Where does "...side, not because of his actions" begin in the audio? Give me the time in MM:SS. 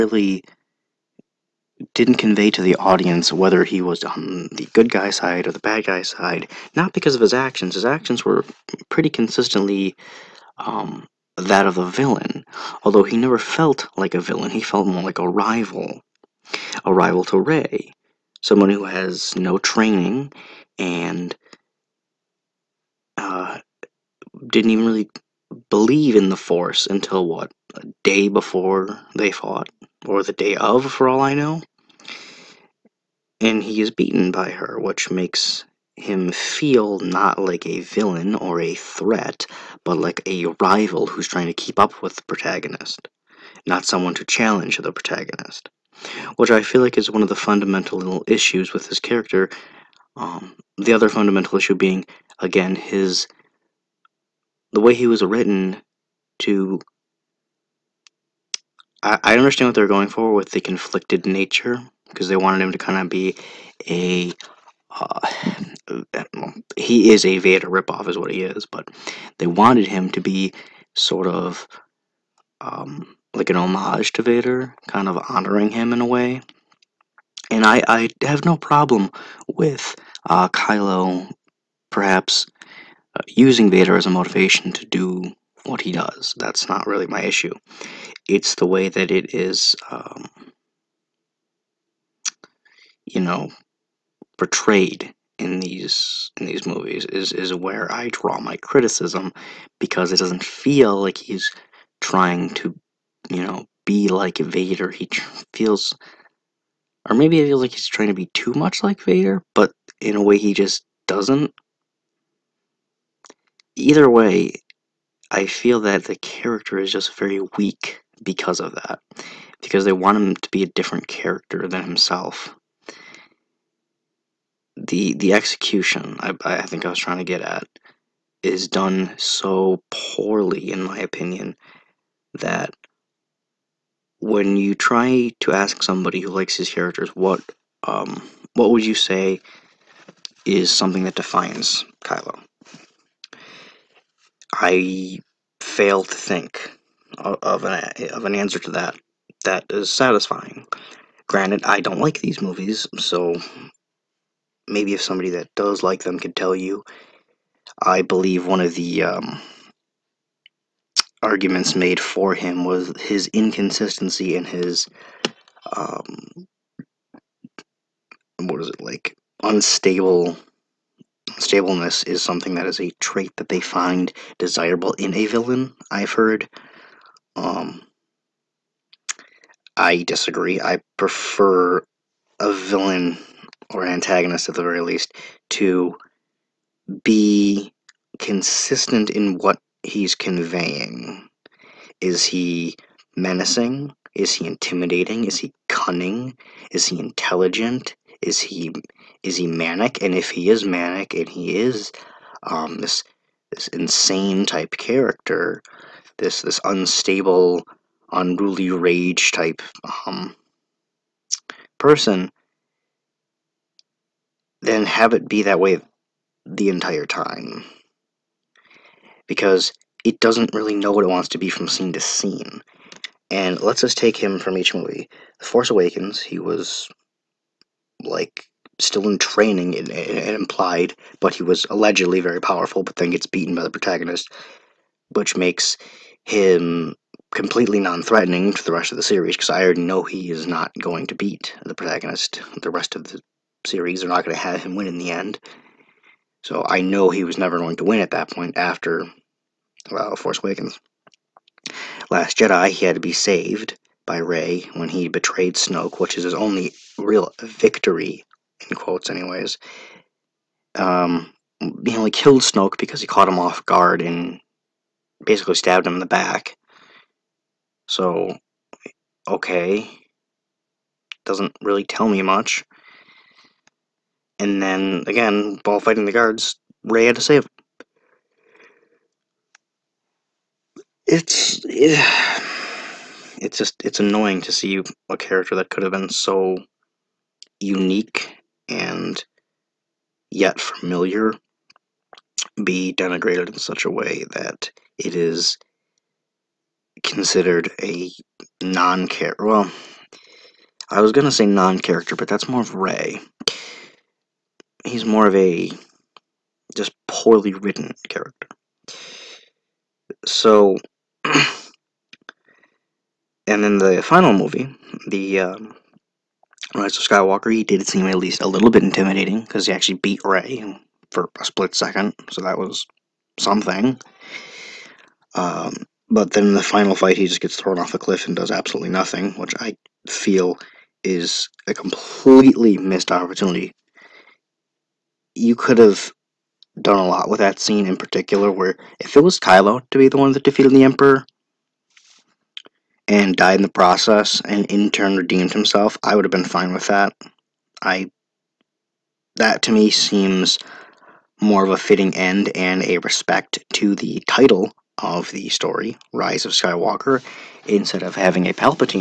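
00:06.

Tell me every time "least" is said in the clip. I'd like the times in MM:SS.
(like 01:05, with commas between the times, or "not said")
03:04, 05:18.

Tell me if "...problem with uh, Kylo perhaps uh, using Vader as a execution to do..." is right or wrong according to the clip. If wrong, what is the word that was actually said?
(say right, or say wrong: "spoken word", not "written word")
wrong: "motivation", not "execution".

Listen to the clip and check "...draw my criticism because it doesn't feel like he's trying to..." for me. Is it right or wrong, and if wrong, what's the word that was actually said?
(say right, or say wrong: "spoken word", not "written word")
right.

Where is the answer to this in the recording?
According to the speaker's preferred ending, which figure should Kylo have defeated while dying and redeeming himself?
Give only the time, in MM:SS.
05:40.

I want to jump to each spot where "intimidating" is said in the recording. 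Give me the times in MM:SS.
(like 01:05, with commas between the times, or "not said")
03:14, 05:18.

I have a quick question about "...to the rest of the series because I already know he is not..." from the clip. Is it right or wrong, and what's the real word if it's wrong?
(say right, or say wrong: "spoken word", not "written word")
right.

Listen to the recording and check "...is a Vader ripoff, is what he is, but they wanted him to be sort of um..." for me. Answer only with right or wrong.
right.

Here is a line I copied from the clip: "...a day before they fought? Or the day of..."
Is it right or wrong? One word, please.
right.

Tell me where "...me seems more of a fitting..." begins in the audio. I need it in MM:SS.
05:49.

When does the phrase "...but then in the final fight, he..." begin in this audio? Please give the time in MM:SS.
05:26.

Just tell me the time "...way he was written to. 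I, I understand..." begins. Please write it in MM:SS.
00:54.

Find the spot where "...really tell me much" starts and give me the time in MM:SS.
04:31.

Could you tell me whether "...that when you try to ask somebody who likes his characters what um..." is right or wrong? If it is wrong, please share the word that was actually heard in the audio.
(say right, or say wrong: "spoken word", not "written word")
right.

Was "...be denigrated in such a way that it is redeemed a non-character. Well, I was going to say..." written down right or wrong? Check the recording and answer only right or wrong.
wrong.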